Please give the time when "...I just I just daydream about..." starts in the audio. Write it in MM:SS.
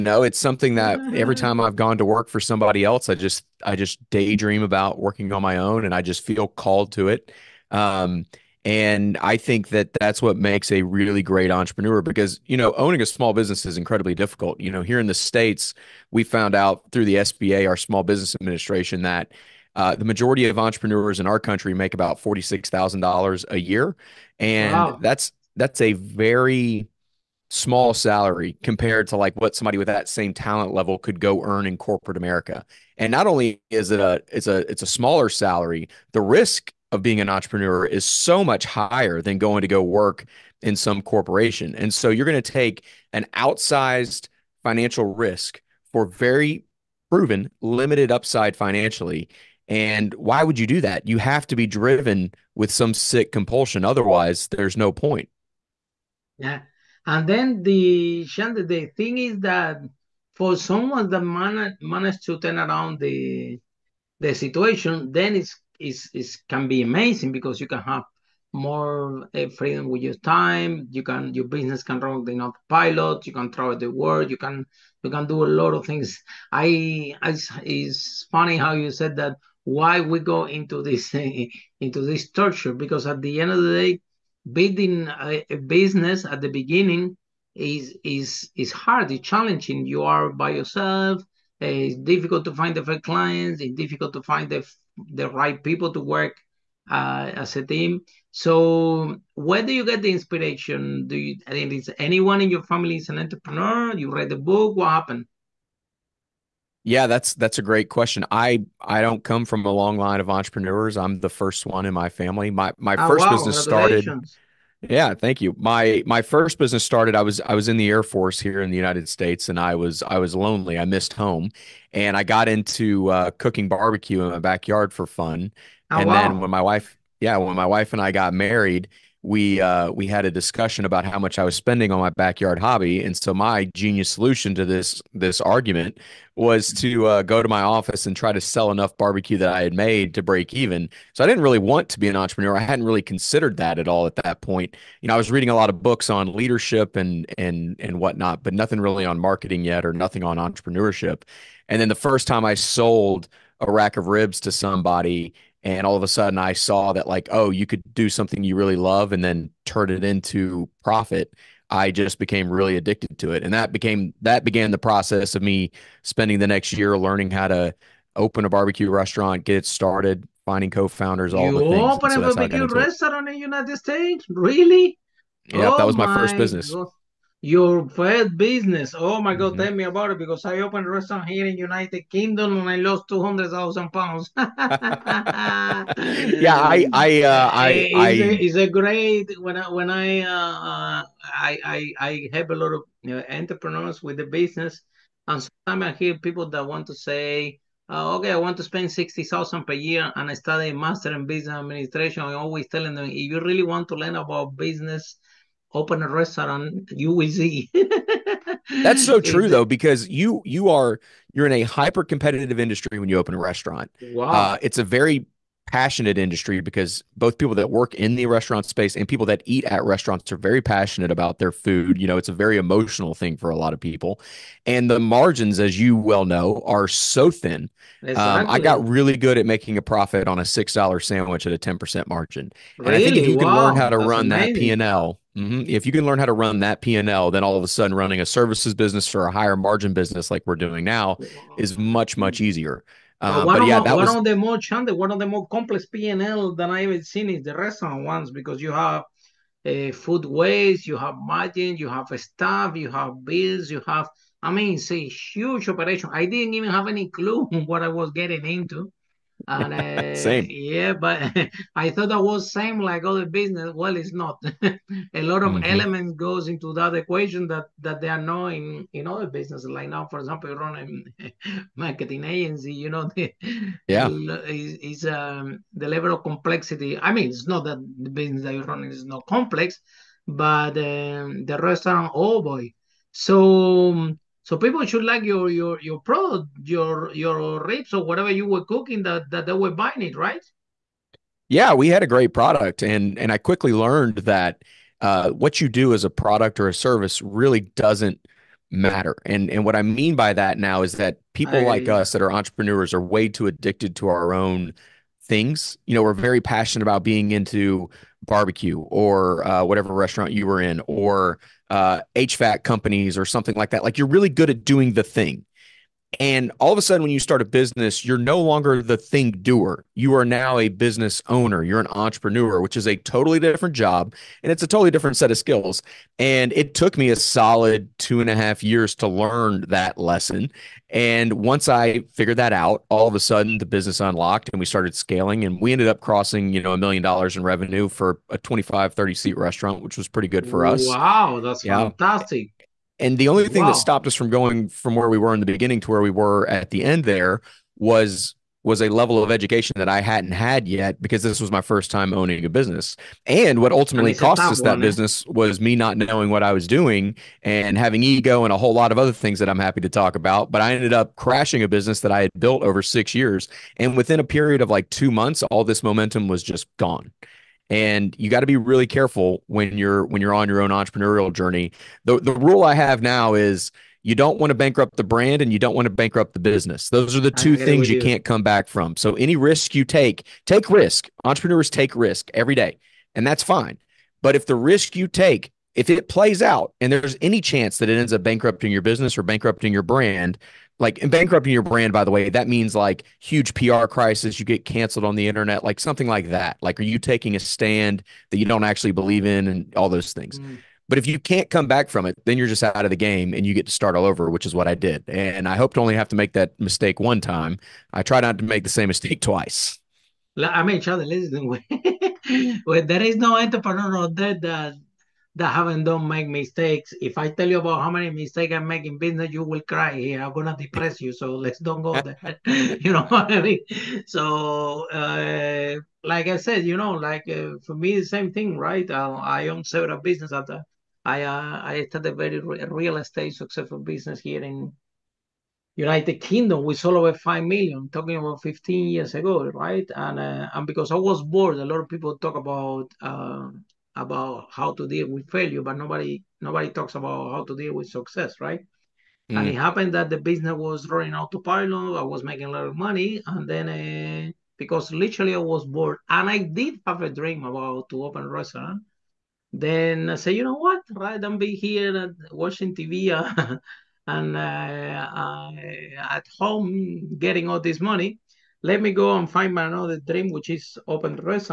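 00:03.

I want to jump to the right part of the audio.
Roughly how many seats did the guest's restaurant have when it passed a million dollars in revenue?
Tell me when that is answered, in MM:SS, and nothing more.
05:38.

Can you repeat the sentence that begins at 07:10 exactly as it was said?
After I uh, I started a very re- real estate successful business here in United Kingdom We sold over five million.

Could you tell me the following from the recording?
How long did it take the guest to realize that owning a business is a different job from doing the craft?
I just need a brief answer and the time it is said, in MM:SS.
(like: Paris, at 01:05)
2 and a half years, at 05:27.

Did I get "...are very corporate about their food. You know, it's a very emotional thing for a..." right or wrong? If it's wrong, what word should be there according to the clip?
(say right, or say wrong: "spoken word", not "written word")
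wrong: "passionate", not "corporate".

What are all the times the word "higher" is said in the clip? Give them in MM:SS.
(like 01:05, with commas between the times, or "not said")
00:38, 03:59.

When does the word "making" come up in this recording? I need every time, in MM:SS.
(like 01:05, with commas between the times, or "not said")
03:49, 07:32.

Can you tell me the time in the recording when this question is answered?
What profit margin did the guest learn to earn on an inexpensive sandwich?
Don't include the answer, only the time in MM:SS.
03:51.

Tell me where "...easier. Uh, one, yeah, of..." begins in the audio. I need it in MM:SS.
04:02.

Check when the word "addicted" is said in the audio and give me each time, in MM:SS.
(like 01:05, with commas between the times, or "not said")
02:42, 05:03.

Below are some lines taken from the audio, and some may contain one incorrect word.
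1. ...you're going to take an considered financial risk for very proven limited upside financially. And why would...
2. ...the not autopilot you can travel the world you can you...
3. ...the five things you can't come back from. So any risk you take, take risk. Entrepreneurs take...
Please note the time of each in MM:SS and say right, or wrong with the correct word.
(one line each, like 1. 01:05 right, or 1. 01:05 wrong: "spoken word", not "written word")
1. 00:42 wrong: "outsized", not "considered"
2. 01:12 wrong: "pilot", not "autopilot"
3. 06:17 wrong: "two", not "five".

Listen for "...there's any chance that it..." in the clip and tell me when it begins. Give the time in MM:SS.
06:26.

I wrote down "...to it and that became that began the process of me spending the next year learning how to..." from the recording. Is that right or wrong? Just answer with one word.
right.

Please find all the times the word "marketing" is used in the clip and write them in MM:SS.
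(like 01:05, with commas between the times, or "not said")
02:29, 04:31.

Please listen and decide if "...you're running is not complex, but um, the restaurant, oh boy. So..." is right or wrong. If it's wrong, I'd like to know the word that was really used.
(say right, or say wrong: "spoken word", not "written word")
right.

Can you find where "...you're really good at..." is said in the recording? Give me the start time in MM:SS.
05:13.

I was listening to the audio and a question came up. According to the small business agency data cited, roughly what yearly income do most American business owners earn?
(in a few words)
$46,000.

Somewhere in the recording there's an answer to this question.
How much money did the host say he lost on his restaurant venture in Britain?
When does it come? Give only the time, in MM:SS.
03:03.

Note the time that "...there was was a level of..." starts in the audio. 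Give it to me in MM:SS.
05:47.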